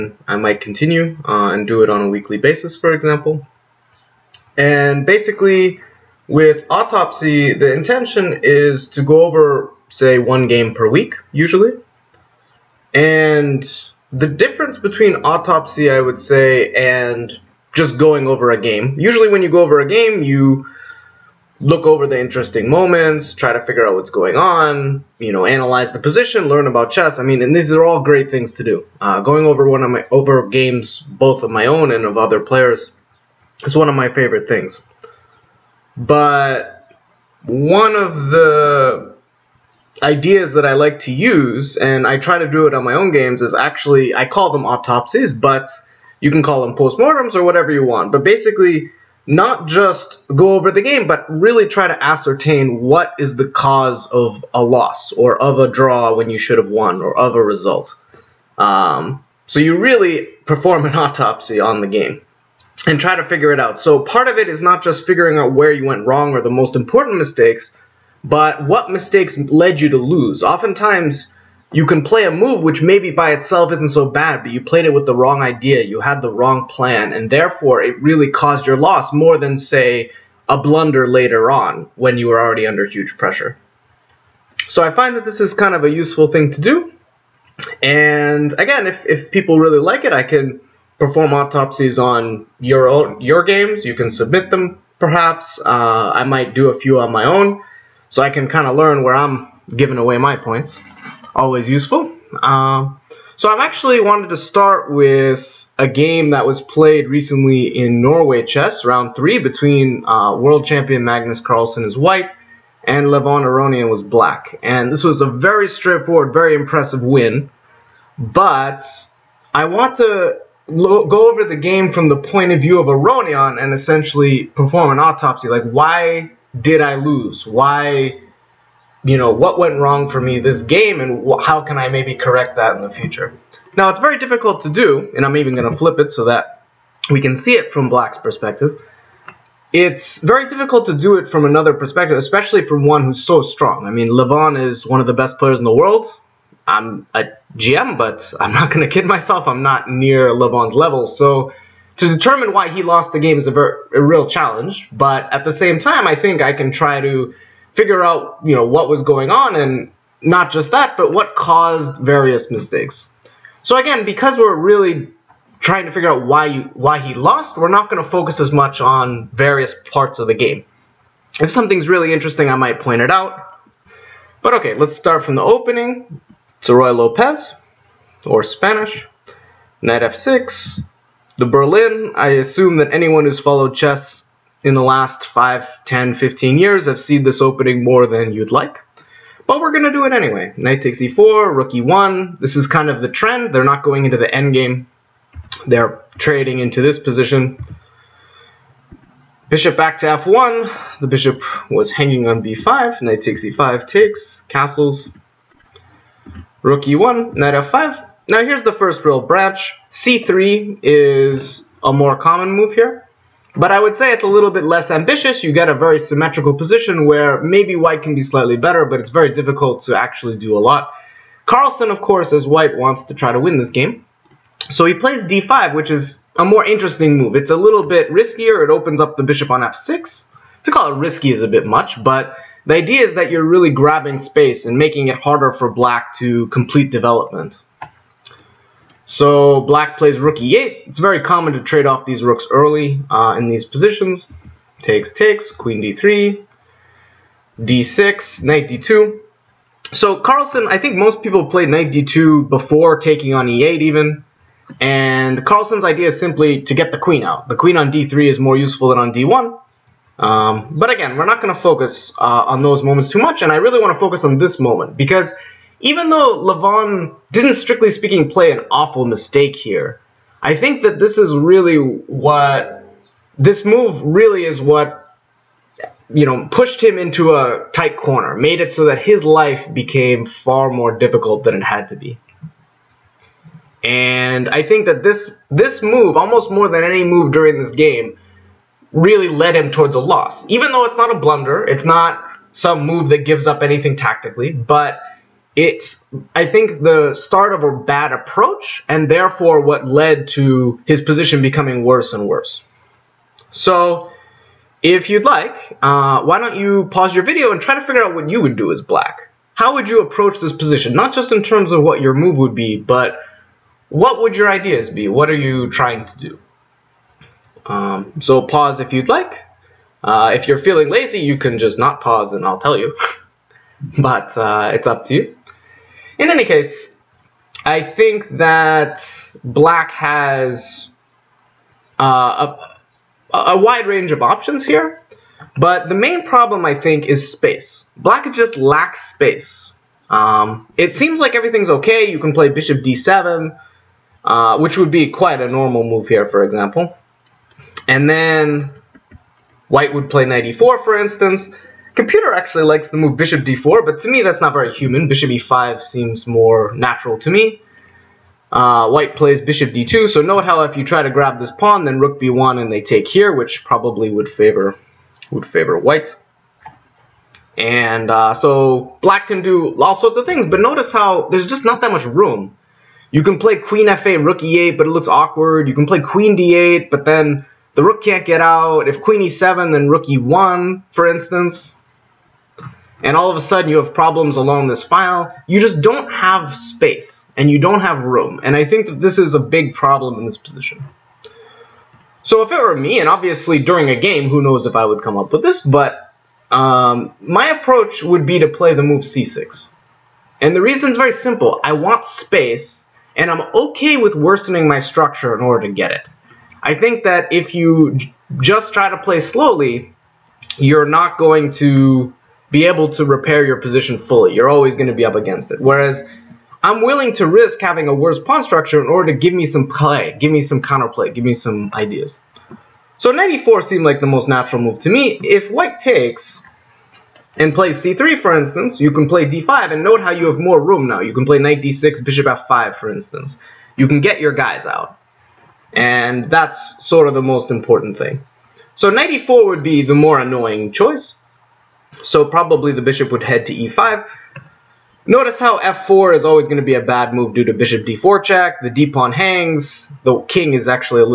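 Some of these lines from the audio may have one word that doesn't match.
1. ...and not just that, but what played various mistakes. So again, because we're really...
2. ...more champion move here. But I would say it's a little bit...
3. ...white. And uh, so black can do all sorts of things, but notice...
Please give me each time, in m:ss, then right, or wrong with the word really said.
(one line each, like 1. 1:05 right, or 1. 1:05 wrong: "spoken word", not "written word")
1. 2:39 wrong: "caused", not "played"
2. 3:31 wrong: "common", not "champion"
3. 6:05 right.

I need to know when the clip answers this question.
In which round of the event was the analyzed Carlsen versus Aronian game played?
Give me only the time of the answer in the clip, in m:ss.
1:48.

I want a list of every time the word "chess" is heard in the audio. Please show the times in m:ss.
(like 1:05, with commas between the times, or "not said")
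0:26, 1:48, 3:03.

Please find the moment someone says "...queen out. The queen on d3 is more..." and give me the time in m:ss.
4:16.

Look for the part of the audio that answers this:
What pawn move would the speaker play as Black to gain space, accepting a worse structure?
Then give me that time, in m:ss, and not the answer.
6:39.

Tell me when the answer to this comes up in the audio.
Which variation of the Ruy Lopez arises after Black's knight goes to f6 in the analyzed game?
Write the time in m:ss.
3:01.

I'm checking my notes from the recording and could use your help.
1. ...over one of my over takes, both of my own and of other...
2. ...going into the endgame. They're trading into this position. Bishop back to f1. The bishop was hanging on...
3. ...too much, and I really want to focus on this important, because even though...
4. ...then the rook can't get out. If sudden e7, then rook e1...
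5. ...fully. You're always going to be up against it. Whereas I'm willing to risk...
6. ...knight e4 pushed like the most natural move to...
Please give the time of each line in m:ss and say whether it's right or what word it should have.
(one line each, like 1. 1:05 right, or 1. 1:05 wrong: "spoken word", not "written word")
1. 0:29 wrong: "games", not "takes"
2. 3:13 right
3. 4:23 wrong: "moment", not "important"
4. 6:17 wrong: "queen", not "sudden"
5. 6:53 right
6. 7:03 wrong: "seemed", not "pushed".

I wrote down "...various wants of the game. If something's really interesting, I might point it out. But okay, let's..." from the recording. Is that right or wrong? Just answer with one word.
wrong.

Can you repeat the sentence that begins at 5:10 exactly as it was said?
Not just in terms of what your move would be, but what would your ideas be?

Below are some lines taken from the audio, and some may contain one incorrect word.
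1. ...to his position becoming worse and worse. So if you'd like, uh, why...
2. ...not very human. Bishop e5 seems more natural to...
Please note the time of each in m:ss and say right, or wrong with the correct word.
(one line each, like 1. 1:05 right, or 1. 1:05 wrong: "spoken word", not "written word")
1. 5:00 right
2. 5:54 right.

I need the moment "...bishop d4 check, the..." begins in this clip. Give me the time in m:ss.
7:27.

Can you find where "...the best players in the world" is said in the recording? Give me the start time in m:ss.
2:25.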